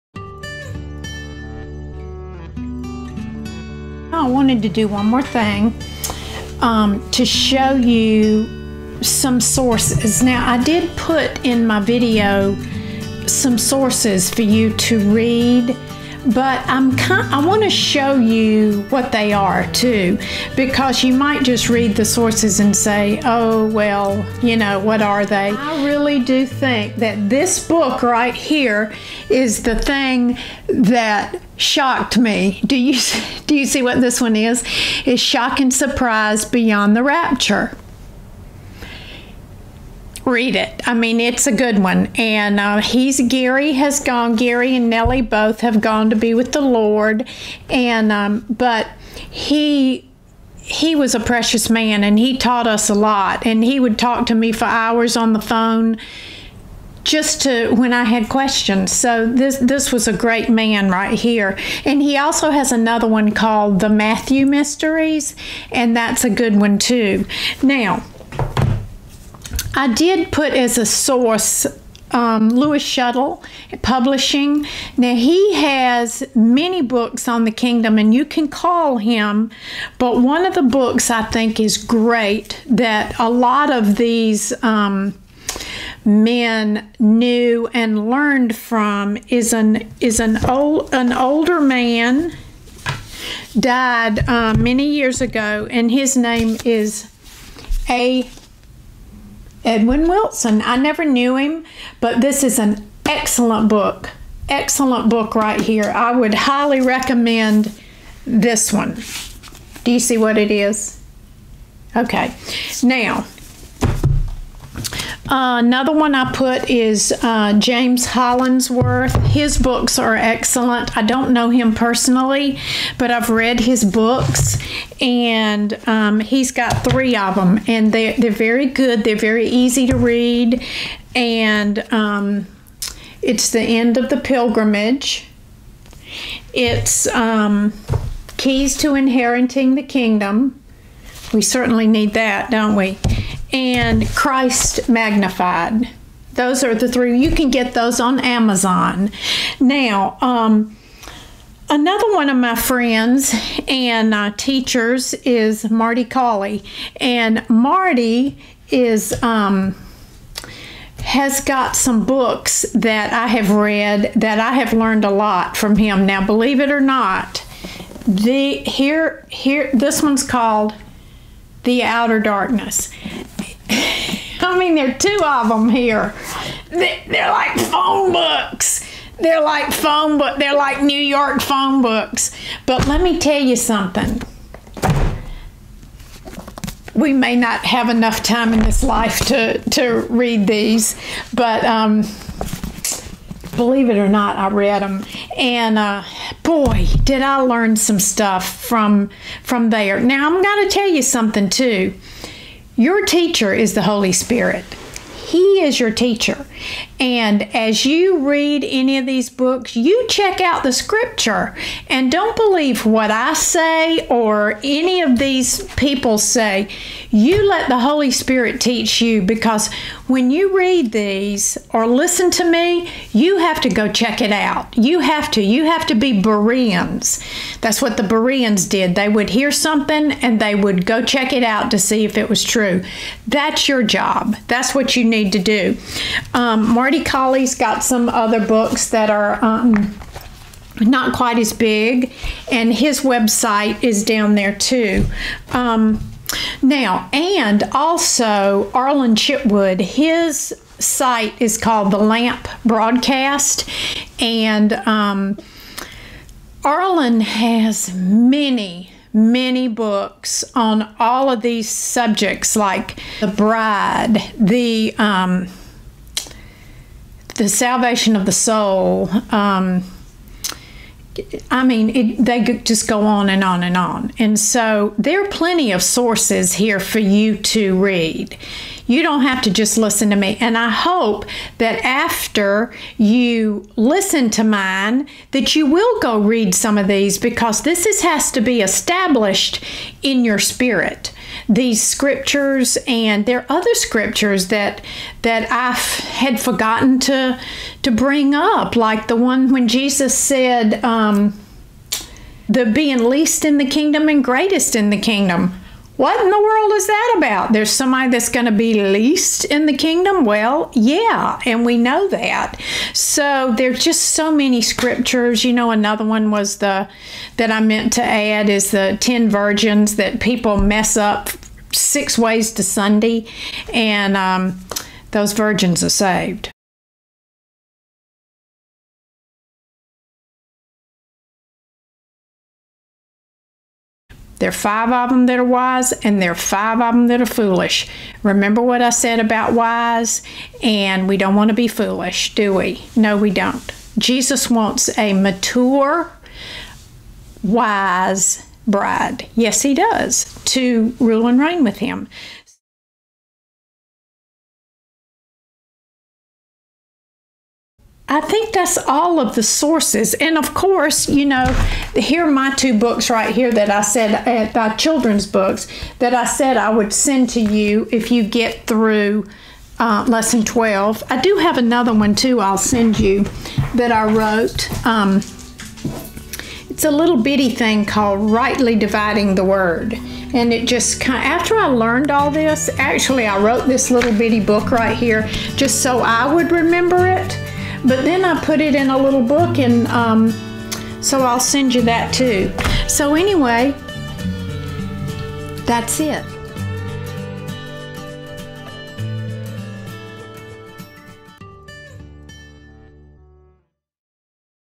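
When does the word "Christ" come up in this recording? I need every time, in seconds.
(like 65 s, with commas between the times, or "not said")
144 s.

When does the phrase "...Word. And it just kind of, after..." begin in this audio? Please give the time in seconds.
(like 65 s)
379 s.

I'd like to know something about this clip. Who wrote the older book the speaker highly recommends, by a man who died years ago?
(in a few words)
A. Edwin Wilson.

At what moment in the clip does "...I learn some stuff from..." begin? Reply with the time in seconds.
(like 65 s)
197 s.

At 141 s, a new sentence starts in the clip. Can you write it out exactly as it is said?
We certainly need that, don't we?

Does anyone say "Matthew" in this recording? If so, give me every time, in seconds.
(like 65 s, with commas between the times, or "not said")
63 s.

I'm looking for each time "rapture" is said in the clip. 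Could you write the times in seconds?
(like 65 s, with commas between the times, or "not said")
37 s.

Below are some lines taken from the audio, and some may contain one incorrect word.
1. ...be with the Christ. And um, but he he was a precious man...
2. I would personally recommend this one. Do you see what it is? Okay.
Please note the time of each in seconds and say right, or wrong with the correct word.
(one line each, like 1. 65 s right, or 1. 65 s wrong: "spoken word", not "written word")
1. 46 s wrong: "Lord", not "Christ"
2. 105 s wrong: "highly", not "personally".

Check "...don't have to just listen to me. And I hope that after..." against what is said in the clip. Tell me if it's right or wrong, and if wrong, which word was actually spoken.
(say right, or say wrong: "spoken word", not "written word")
right.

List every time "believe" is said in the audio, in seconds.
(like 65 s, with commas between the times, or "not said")
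166 s, 193 s, 212 s.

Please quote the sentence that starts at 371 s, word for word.
I do have another one too I'll send you that I wrote.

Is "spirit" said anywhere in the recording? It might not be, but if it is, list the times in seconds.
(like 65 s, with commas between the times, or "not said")
204 s, 218 s, 290 s.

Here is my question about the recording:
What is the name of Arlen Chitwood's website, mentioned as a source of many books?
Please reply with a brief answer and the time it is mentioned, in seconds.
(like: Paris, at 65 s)
The Lamp Broadcast, at 251 s.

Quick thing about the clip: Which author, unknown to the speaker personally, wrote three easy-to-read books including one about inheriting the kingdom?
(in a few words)
James Hollingsworth.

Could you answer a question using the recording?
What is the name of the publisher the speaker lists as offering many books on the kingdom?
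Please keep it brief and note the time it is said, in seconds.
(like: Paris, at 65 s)
Lewis Schoettle Publishing, at 72 s.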